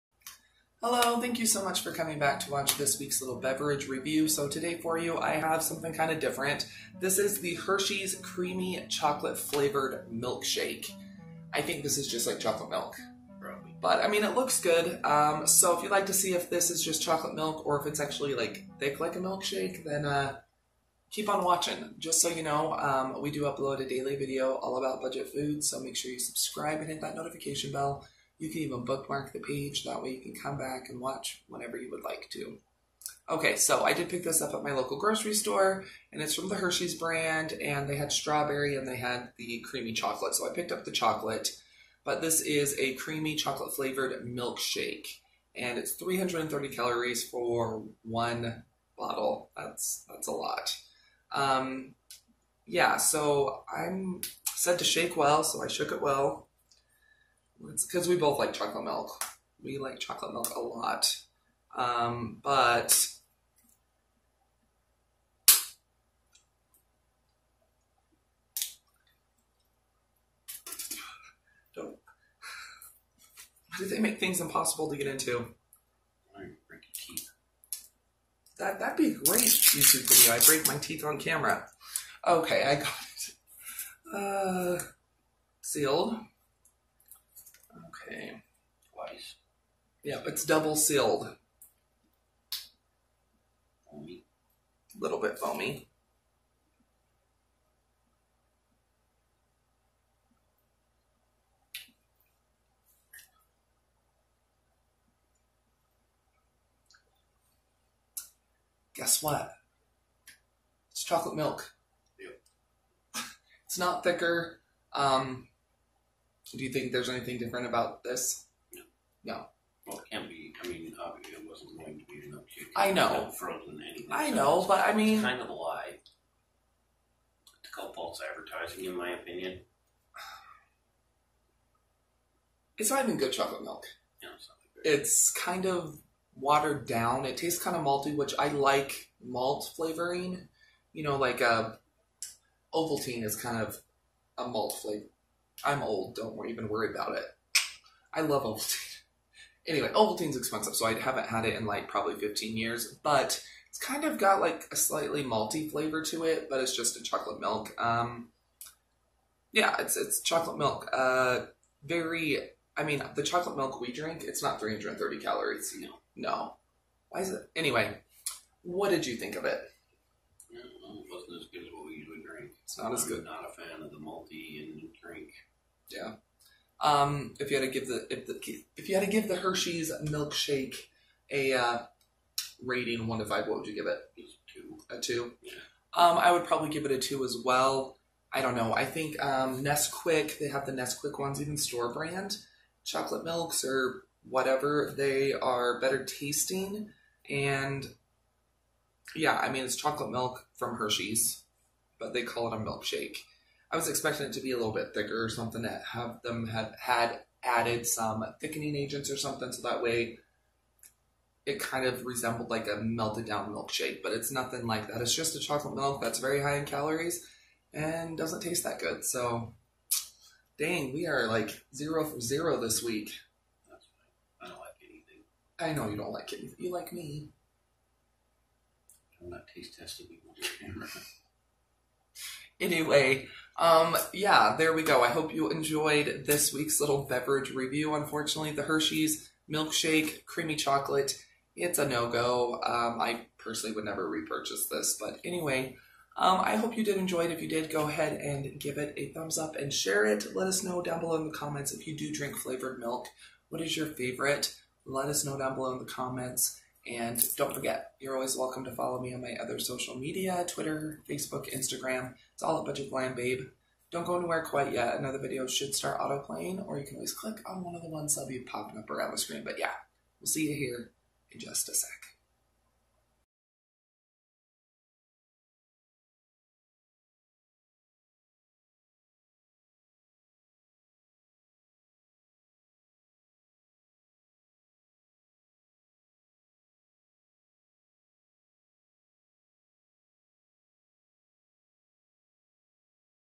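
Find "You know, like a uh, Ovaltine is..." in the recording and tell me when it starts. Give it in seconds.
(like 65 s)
140 s.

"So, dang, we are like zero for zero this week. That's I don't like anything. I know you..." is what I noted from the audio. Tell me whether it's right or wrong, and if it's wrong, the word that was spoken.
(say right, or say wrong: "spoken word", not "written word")
right.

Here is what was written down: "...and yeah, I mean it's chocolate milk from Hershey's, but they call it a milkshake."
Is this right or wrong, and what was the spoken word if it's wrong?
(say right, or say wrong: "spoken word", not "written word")
right.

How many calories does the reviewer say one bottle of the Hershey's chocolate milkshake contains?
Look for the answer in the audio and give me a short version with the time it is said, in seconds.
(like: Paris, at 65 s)
330, at 45 s.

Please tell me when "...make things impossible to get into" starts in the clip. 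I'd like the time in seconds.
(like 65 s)
73 s.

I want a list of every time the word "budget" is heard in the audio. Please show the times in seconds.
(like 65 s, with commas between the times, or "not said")
24 s, 262 s.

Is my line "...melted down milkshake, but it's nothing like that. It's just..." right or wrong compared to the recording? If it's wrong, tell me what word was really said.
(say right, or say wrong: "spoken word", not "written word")
right.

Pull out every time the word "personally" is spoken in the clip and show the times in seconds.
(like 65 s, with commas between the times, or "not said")
243 s.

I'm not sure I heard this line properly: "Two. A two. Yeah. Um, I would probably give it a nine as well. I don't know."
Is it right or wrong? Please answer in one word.
wrong.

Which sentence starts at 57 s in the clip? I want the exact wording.
It's because we both like chocolate milk.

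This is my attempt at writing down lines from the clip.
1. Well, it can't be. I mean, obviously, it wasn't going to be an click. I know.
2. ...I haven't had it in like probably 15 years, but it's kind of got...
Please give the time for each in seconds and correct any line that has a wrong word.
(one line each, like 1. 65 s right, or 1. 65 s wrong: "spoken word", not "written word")
1. 119 s wrong: "uptick", not "click"
2. 150 s right.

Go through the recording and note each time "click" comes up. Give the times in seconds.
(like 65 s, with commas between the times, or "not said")
267 s.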